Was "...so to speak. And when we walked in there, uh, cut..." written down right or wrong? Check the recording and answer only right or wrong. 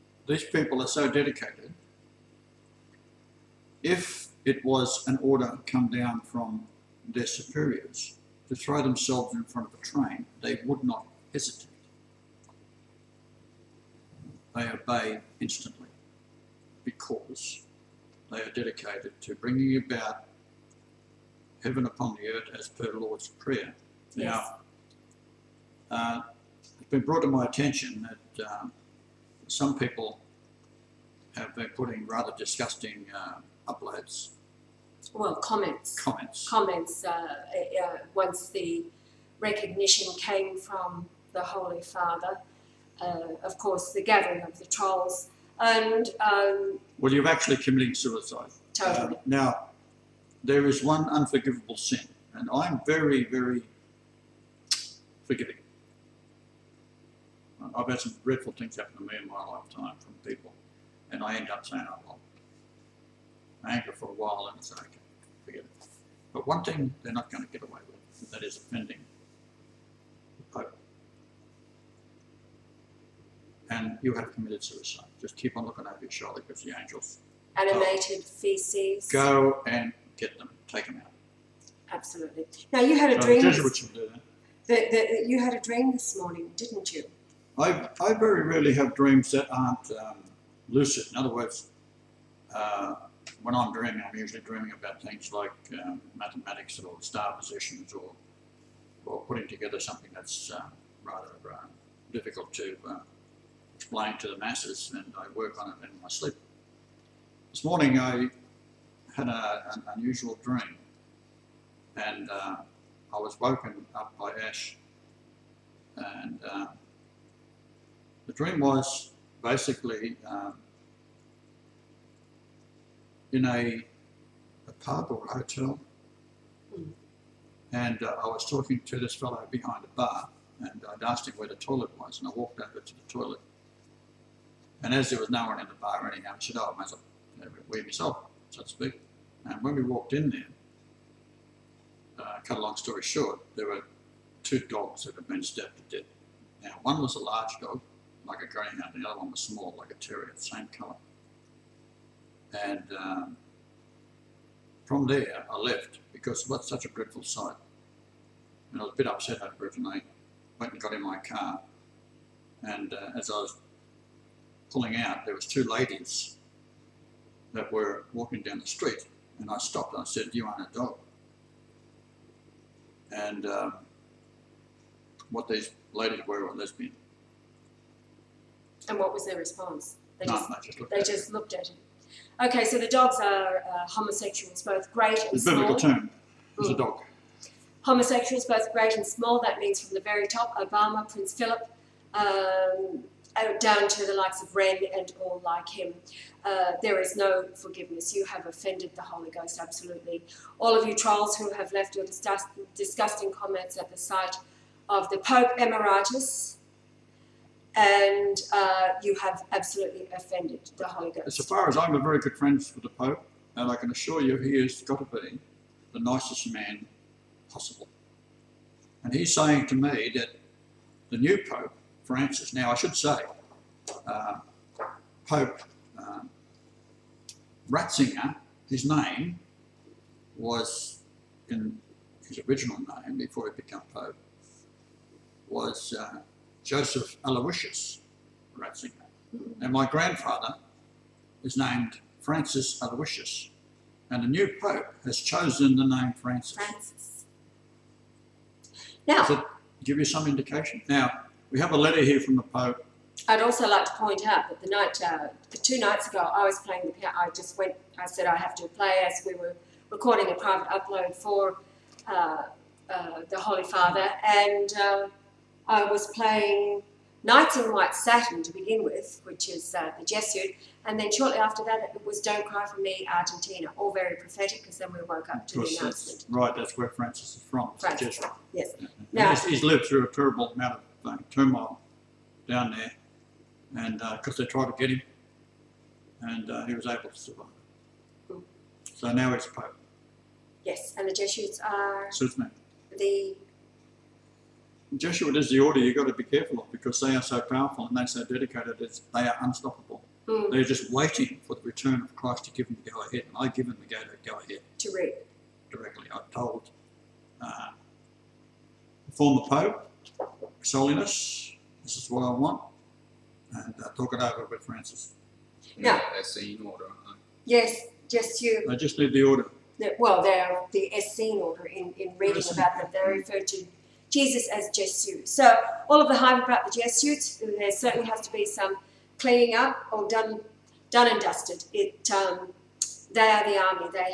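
right.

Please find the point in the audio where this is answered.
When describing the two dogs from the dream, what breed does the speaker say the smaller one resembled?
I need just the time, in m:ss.
2:29.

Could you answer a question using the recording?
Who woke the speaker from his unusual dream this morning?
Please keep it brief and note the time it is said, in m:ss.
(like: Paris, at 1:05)
Ash, at 1:54.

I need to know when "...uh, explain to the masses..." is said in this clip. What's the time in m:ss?
1:42.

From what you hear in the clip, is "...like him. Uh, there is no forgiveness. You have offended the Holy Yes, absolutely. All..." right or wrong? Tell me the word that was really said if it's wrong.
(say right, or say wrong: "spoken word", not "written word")
wrong: "Ghost", not "Yes".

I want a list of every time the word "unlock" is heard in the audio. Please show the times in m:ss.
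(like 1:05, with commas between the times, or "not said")
not said.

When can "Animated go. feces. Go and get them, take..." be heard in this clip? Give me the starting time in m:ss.
1:17.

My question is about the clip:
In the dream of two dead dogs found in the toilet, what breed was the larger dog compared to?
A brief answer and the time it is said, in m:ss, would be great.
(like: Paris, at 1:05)
Greyhound, at 2:28.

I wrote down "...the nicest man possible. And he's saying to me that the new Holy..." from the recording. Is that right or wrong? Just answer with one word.
wrong.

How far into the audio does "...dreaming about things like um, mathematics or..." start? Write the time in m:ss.
1:34.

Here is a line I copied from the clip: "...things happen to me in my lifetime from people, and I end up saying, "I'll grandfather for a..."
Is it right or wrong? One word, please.
wrong.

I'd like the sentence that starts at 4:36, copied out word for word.
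right, that's where Francis is from.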